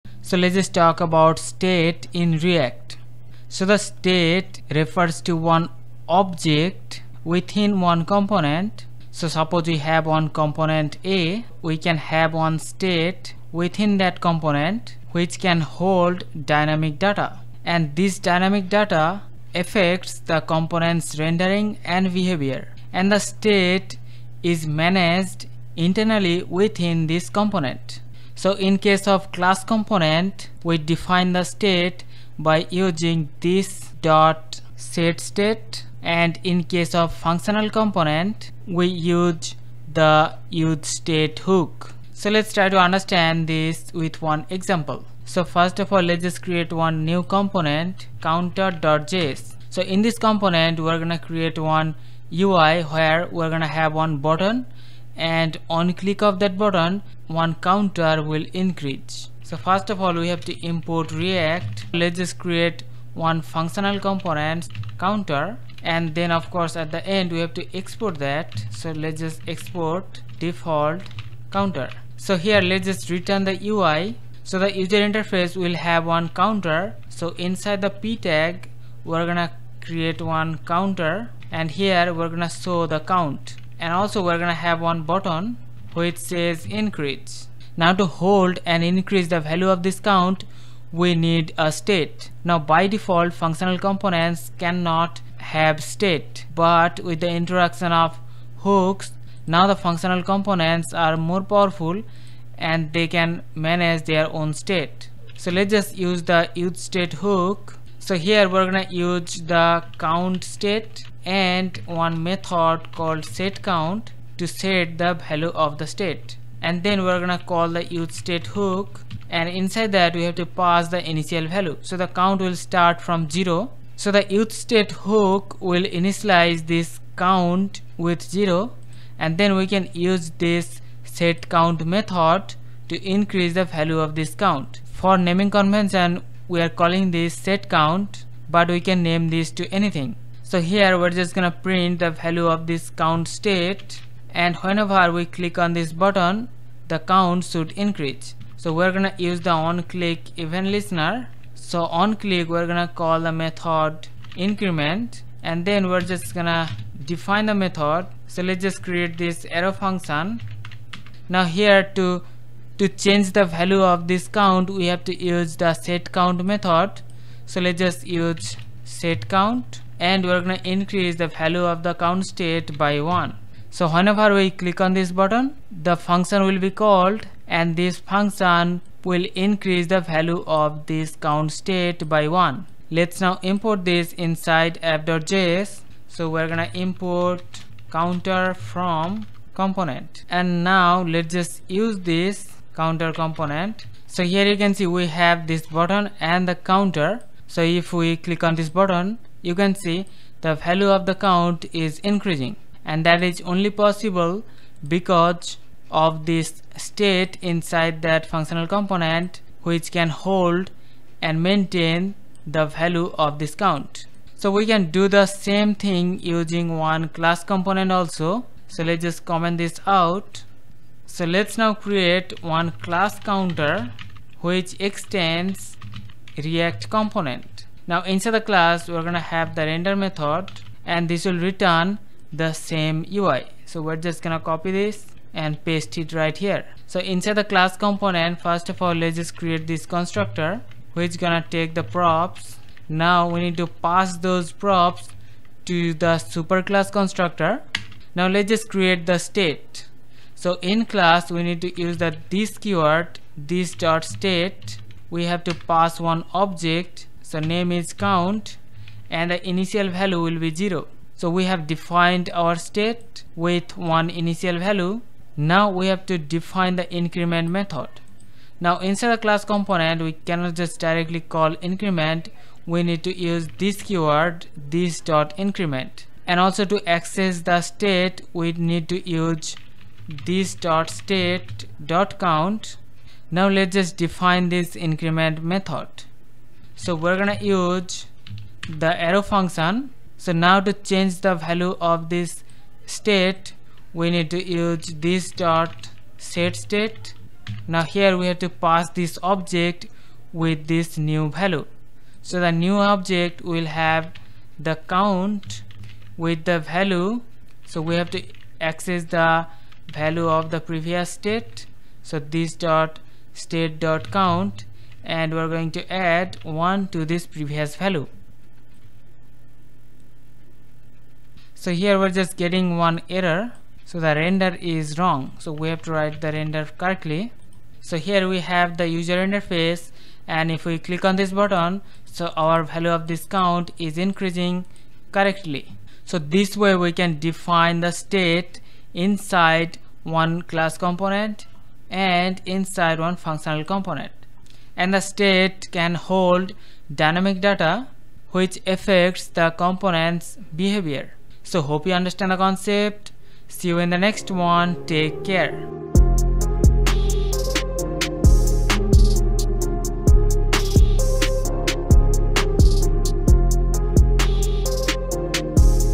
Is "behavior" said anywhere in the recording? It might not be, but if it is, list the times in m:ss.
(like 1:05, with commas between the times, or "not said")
0:22, 5:50.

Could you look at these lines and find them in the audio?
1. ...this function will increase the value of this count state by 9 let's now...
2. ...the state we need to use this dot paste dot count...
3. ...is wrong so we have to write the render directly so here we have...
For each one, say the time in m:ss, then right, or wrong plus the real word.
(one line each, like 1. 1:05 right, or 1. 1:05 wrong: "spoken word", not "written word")
1. 2:57 wrong: "1", not "9"
2. 4:37 wrong: "state", not "paste"
3. 5:24 wrong: "correctly", not "directly".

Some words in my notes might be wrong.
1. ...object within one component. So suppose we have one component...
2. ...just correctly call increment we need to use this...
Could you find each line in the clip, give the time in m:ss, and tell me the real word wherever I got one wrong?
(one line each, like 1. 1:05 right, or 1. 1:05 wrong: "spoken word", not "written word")
1. 0:06 right
2. 4:30 wrong: "directly", not "correctly".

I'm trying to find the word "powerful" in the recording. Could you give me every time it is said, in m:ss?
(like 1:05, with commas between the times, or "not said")
1:41.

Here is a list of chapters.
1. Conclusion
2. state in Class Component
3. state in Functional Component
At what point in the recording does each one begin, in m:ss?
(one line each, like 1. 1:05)
1. 5:36
2. 3:34
3. 0:45.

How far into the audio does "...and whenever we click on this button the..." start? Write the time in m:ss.
2:24.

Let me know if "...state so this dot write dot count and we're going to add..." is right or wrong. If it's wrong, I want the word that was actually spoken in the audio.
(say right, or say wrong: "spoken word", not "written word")
wrong: "state", not "write".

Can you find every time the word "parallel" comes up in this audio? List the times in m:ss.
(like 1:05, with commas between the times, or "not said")
not said.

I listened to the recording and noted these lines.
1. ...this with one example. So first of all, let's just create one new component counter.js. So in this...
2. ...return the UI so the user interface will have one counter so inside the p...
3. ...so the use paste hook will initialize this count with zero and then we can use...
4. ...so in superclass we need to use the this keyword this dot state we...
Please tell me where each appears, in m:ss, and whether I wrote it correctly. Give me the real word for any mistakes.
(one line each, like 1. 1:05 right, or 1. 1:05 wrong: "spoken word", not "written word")
1. 0:43 right
2. 1:13 right
3. 2:03 wrong: "state", not "paste"
4. 4:10 wrong: "class", not "superclass".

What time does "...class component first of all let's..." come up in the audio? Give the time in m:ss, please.
3:57.